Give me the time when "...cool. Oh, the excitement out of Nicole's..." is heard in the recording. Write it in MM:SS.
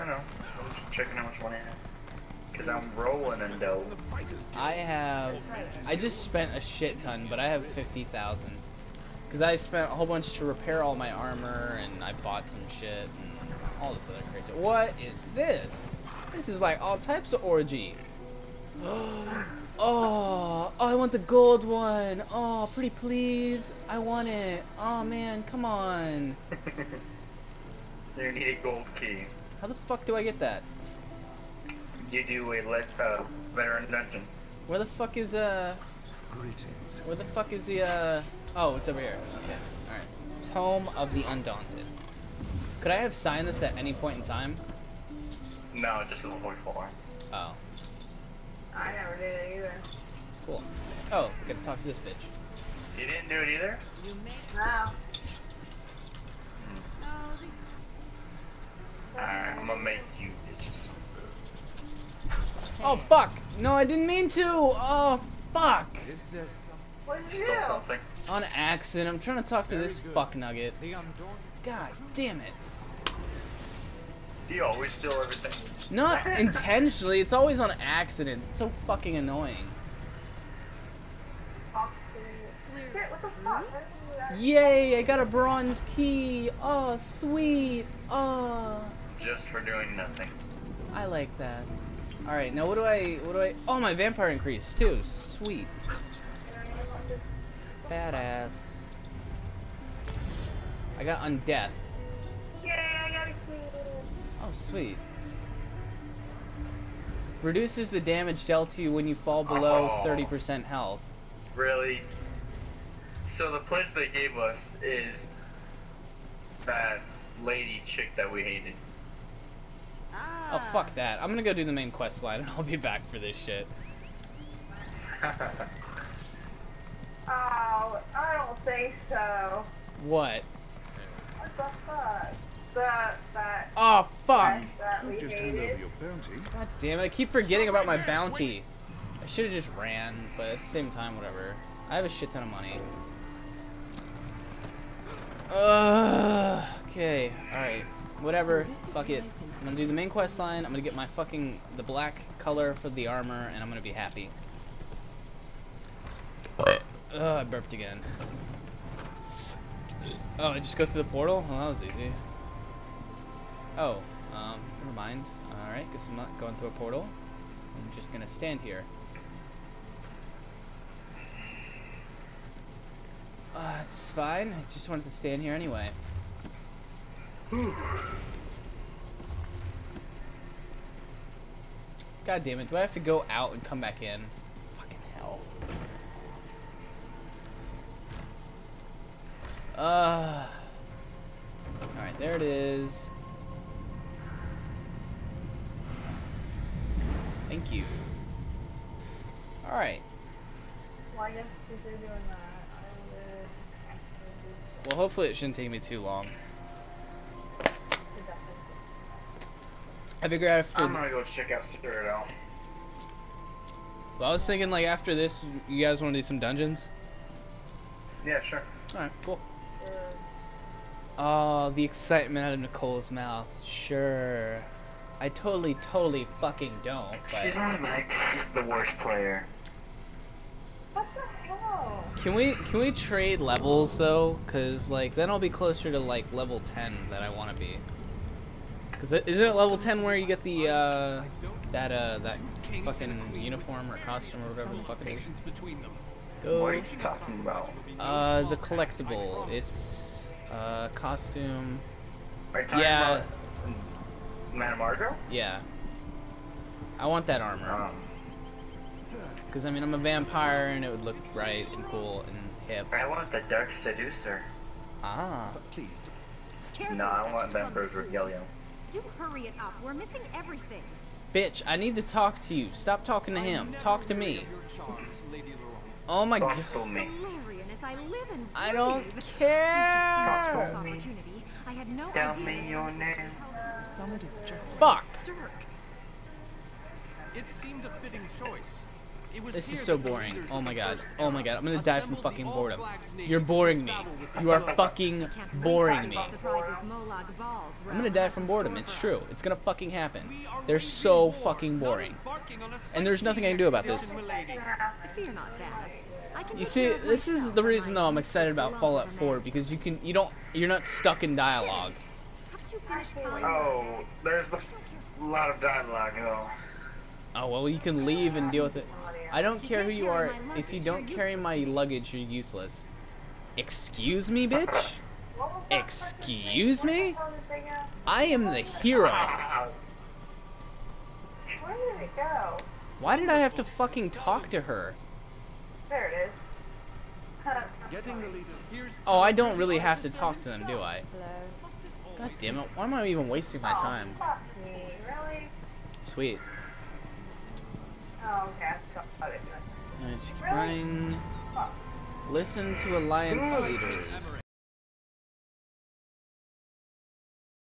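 03:39.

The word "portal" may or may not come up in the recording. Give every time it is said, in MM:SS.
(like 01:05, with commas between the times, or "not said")
02:41, 02:46.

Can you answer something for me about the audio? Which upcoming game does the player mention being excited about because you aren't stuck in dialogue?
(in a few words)
Fallout 4.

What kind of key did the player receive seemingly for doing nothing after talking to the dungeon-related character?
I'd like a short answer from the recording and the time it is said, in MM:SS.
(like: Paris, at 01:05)
bronze key, at 01:25.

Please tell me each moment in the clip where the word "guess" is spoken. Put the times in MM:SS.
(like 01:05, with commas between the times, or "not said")
02:45.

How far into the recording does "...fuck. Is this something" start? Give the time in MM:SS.
01:05.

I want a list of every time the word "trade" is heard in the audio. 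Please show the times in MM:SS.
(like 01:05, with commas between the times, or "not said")
03:52.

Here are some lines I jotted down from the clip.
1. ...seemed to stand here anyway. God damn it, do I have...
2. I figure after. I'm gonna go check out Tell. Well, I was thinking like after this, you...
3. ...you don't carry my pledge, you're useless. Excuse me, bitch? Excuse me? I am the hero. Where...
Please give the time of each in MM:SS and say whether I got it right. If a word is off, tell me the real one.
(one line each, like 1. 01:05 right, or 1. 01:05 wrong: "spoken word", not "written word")
1. 02:54 wrong: "wanted", not "seemed"
2. 03:30 wrong: "Citadel", not "Tell"
3. 05:20 wrong: "luggage", not "pledge".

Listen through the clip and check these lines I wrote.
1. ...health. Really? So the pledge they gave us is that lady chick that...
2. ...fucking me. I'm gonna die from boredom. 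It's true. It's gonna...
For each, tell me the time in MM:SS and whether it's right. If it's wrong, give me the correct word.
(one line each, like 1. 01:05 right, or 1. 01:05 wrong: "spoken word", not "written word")
1. 01:50 right
2. 04:55 wrong: "boring", not "fucking".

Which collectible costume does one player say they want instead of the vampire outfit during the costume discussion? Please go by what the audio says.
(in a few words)
Dark Seducer.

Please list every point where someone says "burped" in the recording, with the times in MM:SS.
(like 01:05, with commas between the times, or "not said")
02:37.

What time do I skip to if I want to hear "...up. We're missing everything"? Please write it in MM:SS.
04:29.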